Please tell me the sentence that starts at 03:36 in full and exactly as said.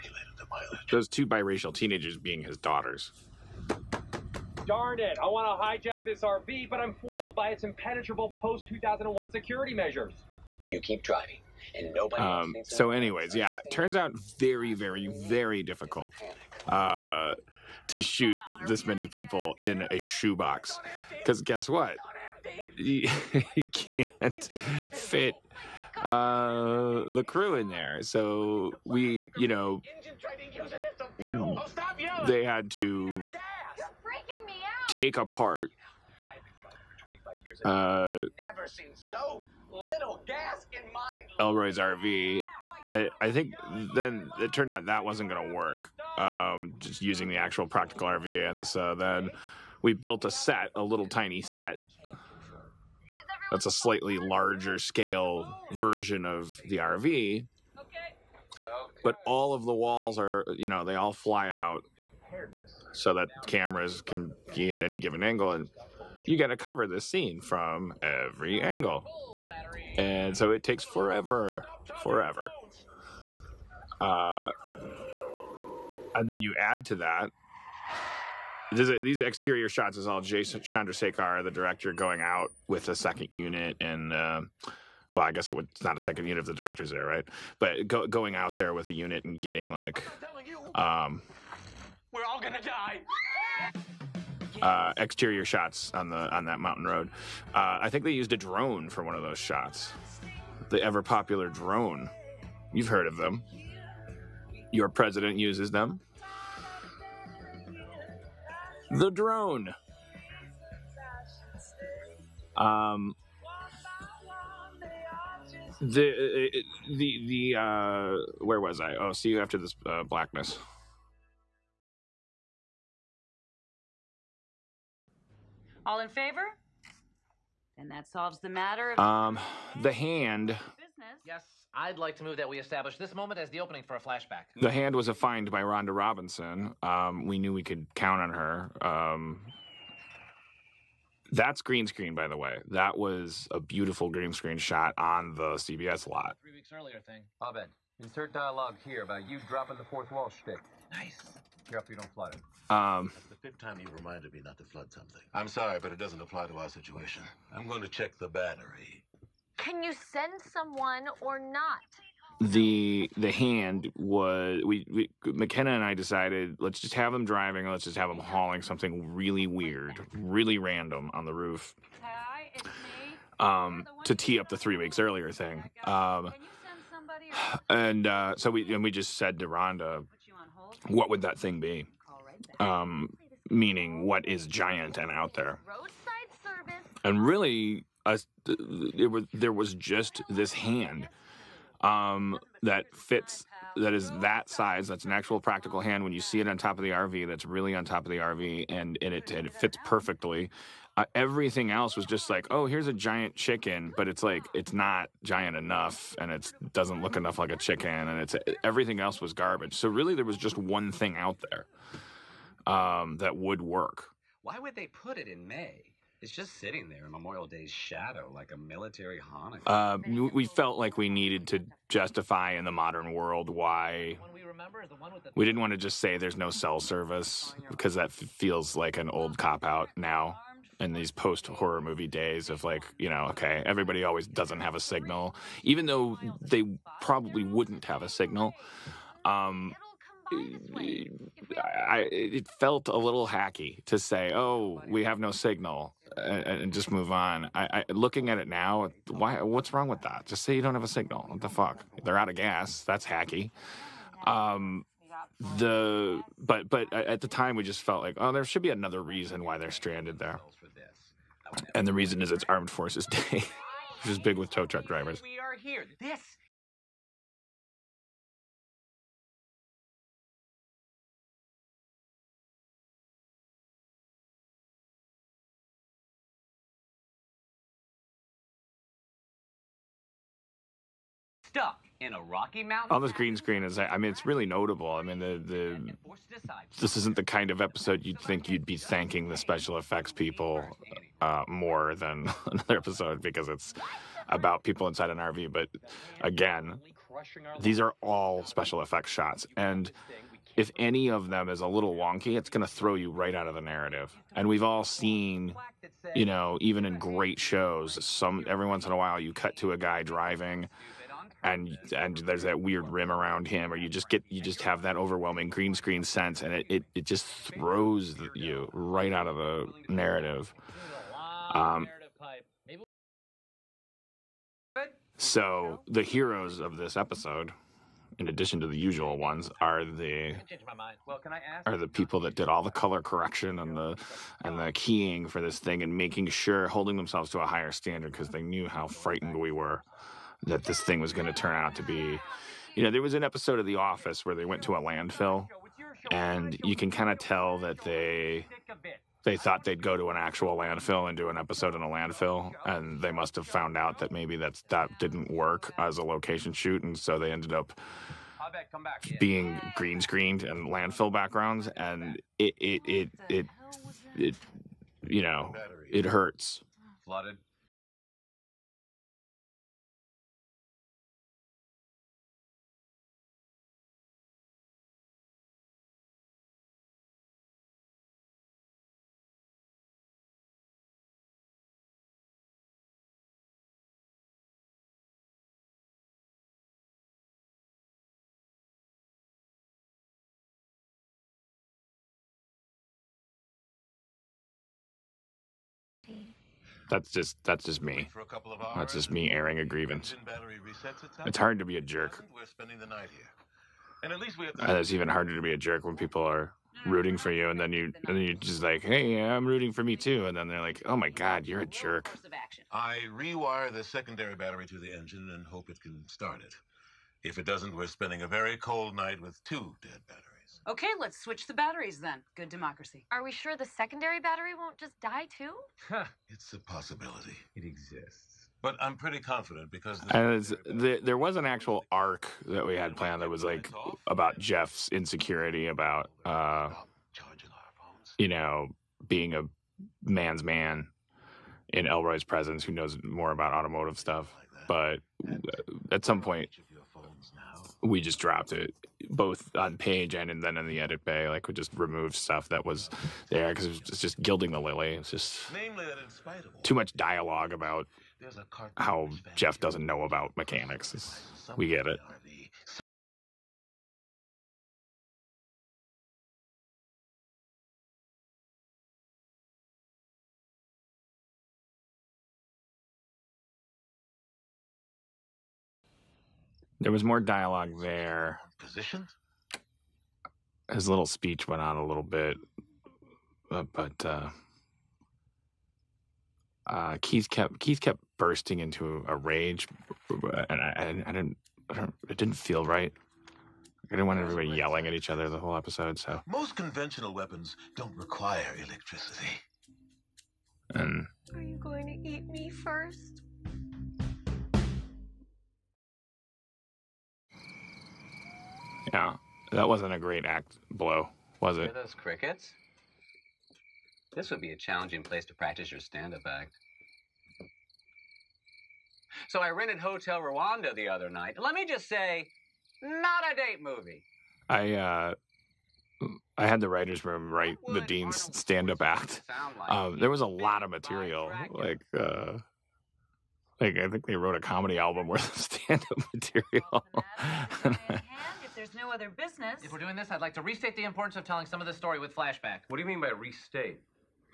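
It's just sitting there in Memorial Day's shadow, like a military Hanukkah.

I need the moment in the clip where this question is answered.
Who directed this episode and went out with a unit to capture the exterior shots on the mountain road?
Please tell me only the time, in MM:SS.
01:20.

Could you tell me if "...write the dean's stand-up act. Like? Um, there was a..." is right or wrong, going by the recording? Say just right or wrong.
right.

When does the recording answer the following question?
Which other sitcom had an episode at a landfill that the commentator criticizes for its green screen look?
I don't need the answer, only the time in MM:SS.
05:43.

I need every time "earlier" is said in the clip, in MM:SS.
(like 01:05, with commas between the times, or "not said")
02:26, 02:54.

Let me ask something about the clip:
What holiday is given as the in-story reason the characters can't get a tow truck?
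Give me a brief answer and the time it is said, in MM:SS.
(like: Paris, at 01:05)
Armed Forces Day, at 04:22.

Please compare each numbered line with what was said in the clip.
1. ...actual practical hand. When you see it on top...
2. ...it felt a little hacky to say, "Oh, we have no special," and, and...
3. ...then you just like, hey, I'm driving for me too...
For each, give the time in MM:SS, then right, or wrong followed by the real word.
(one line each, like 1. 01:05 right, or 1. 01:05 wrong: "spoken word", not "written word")
1. 03:15 right
2. 04:02 wrong: "signal", not "special"
3. 06:48 wrong: "rooting", not "driving".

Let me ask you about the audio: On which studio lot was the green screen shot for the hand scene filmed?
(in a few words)
CBS lot.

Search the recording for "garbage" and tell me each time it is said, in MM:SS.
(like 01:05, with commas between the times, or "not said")
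03:29.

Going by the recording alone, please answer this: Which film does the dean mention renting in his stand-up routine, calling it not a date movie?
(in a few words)
Hotel Rwanda.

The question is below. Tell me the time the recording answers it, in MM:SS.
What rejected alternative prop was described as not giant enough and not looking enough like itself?
03:22.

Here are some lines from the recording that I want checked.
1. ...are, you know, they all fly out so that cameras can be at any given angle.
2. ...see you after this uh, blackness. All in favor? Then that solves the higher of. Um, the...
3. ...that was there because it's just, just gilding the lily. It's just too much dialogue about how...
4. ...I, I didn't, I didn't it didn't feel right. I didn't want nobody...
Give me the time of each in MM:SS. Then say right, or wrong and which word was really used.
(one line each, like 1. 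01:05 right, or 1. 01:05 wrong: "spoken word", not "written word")
1. 01:00 right
2. 01:59 wrong: "matter", not "higher"
3. 07:32 right
4. 08:10 wrong: "everybody", not "nobody".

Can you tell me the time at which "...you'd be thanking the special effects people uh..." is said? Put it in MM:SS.
04:48.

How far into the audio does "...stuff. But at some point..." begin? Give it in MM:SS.
07:23.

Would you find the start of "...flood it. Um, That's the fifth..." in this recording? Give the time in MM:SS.
02:32.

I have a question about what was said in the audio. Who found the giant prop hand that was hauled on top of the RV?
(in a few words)
Rhonda Robinson.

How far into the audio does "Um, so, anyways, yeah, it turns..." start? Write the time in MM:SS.
00:12.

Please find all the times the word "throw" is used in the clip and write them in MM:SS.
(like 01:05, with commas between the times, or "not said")
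05:02, 05:17.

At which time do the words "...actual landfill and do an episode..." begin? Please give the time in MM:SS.
05:50.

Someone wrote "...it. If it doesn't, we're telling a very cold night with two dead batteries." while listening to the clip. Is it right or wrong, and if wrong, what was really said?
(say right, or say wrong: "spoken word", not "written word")
wrong: "spending", not "telling".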